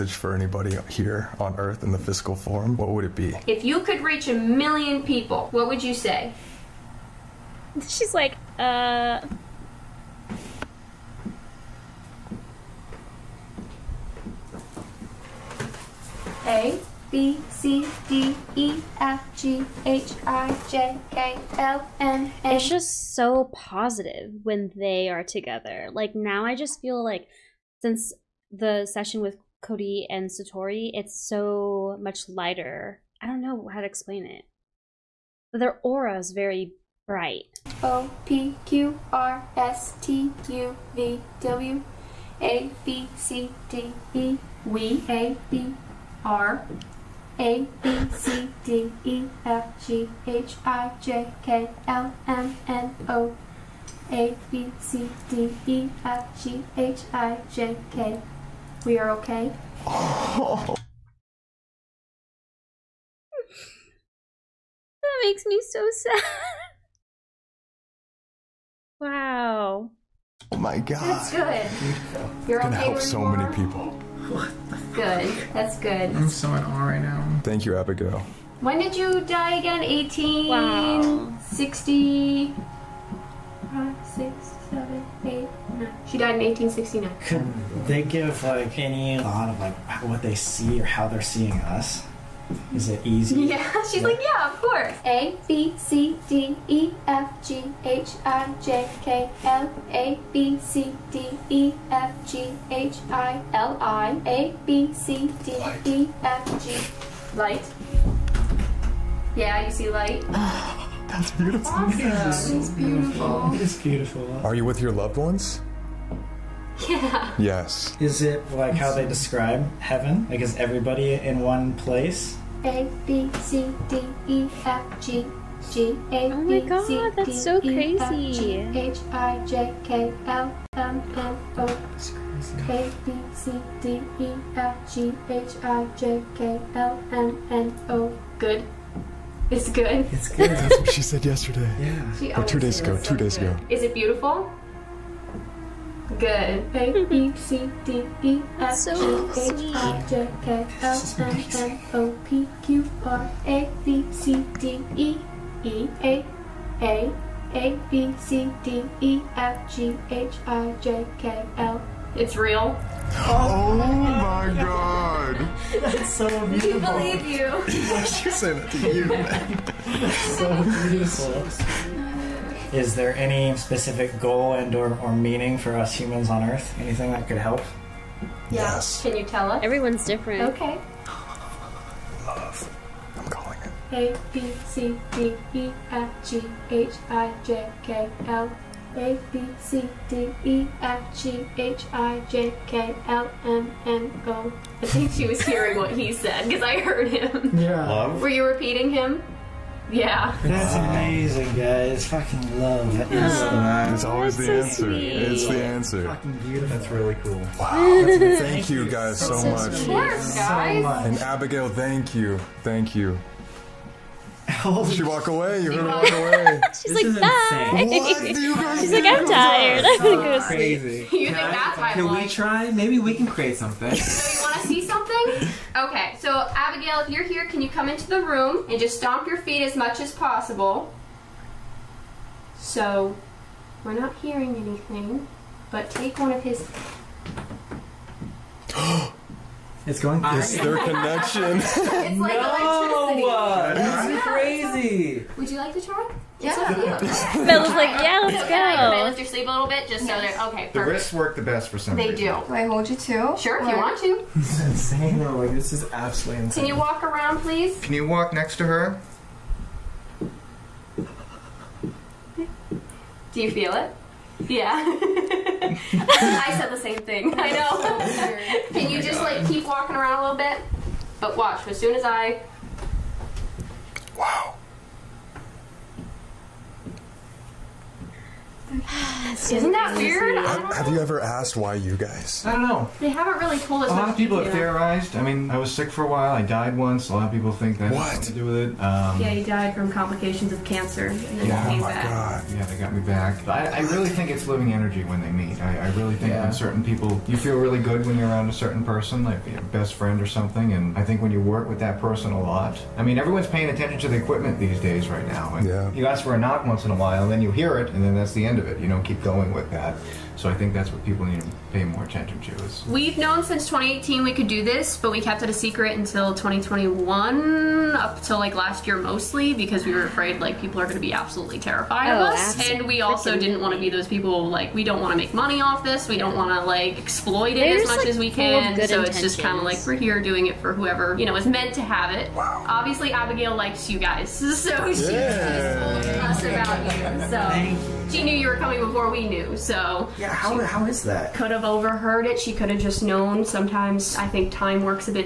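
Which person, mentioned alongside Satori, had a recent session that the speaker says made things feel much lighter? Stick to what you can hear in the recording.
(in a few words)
Cody.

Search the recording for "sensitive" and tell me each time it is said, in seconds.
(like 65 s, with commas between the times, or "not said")
not said.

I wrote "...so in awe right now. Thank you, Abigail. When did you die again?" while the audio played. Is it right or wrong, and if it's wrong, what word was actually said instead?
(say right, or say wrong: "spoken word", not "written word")
right.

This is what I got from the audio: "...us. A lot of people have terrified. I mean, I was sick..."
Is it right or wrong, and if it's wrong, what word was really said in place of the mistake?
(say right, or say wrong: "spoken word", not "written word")
wrong: "theorized", not "terrified".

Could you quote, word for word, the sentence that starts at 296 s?
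when certain people, you feel really good when you're around a certain person, like your best friend or something.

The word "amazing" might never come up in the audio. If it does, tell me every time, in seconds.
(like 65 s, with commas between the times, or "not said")
200 s.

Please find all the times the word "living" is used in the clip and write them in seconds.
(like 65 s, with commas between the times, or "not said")
294 s.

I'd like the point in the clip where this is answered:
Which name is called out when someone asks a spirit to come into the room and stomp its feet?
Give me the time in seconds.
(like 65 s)
227 s.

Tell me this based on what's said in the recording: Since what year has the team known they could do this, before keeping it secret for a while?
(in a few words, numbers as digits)
2018.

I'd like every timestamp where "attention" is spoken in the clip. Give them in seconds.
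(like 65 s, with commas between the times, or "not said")
303 s, 312 s.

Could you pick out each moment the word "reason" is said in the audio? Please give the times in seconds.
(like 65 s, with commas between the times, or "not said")
252 s.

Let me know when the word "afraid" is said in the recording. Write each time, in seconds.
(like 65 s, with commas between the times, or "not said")
320 s.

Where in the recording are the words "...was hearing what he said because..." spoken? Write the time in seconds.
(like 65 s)
195 s.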